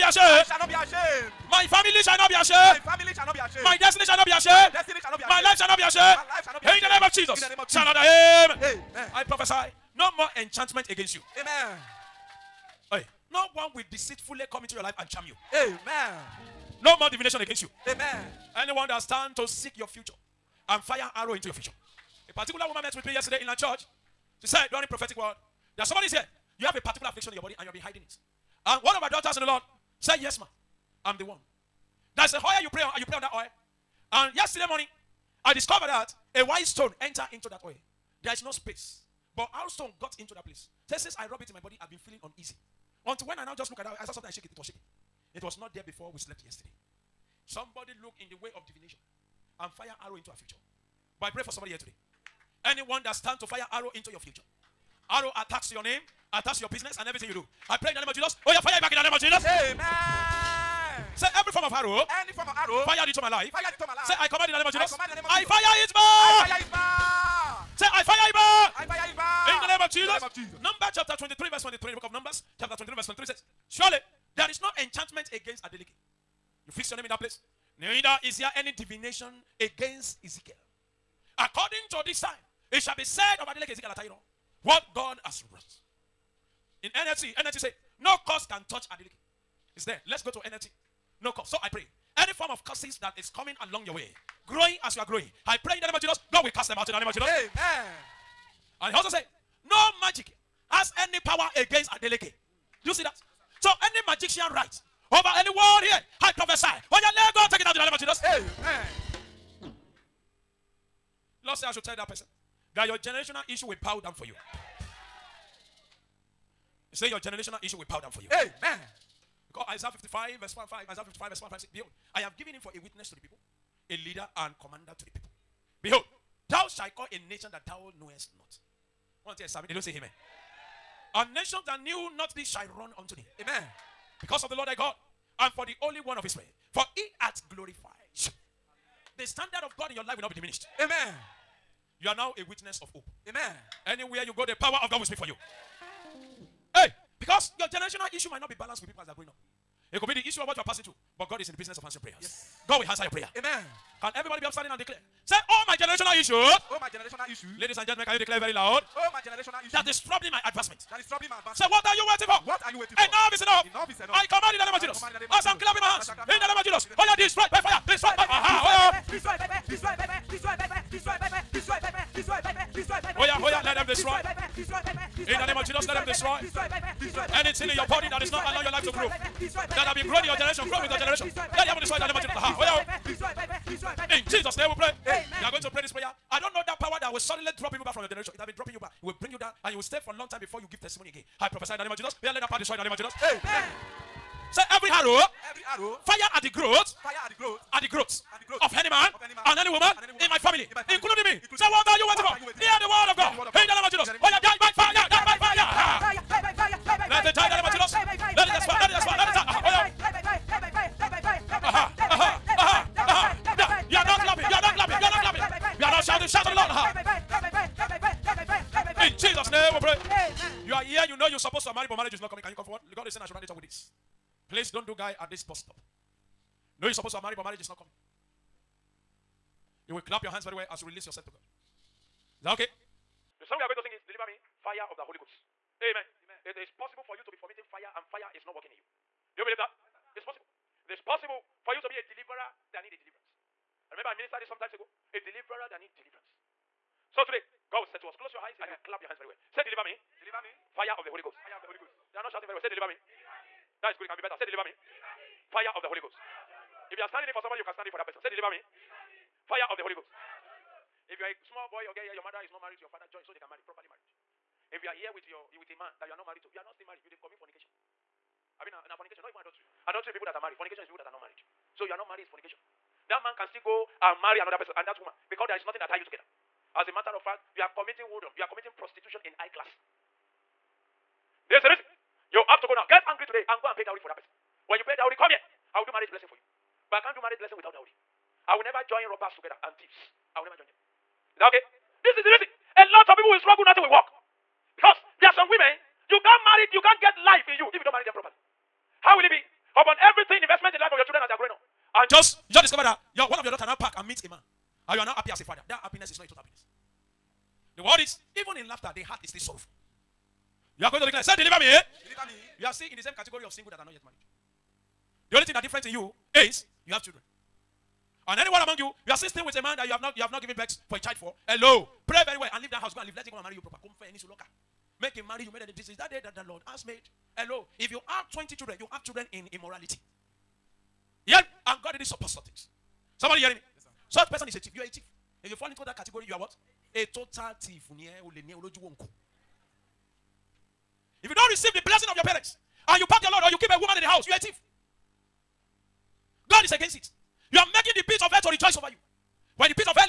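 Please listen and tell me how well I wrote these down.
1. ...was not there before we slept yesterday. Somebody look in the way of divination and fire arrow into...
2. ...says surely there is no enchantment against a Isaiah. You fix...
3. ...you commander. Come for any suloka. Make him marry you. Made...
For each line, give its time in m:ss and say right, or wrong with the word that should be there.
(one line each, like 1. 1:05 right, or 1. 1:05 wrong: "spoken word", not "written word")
1. 0:45 right
2. 1:13 wrong: "Adeleke", not "Isaiah"
3. 5:23 wrong: "proper", not "commander".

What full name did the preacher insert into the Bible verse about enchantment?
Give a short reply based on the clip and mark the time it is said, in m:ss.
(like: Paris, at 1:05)
Adeleke Ezekiel Atayero, at 1:23.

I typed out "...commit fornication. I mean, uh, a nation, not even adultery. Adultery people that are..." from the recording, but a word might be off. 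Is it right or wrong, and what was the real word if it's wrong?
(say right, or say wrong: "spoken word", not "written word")
wrong: "fornication", not "nation".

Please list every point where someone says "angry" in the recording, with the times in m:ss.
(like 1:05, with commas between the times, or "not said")
4:43.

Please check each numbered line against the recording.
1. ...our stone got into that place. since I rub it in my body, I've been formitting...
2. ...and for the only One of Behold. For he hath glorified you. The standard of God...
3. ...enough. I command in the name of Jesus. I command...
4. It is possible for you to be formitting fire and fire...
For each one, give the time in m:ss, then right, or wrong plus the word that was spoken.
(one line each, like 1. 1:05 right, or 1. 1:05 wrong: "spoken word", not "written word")
1. 0:39 wrong: "feeling", not "formitting"
2. 2:15 wrong: "Israel", not "Behold"
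3. 2:43 right
4. 3:56 right.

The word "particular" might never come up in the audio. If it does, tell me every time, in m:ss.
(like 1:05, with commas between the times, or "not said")
0:22, 0:26.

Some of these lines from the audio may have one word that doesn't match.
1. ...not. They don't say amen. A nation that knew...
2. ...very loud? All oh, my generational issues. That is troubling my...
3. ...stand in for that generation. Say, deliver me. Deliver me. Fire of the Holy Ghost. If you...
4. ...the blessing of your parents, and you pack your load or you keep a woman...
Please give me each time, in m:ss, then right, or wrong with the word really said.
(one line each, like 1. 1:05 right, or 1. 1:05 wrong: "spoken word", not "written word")
1. 2:09 right
2. 2:38 right
3. 4:17 wrong: "person", not "generation"
4. 5:41 right.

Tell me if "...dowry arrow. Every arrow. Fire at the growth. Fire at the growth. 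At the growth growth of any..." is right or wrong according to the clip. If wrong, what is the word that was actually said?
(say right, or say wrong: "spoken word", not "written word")
wrong: "every", not "dowry".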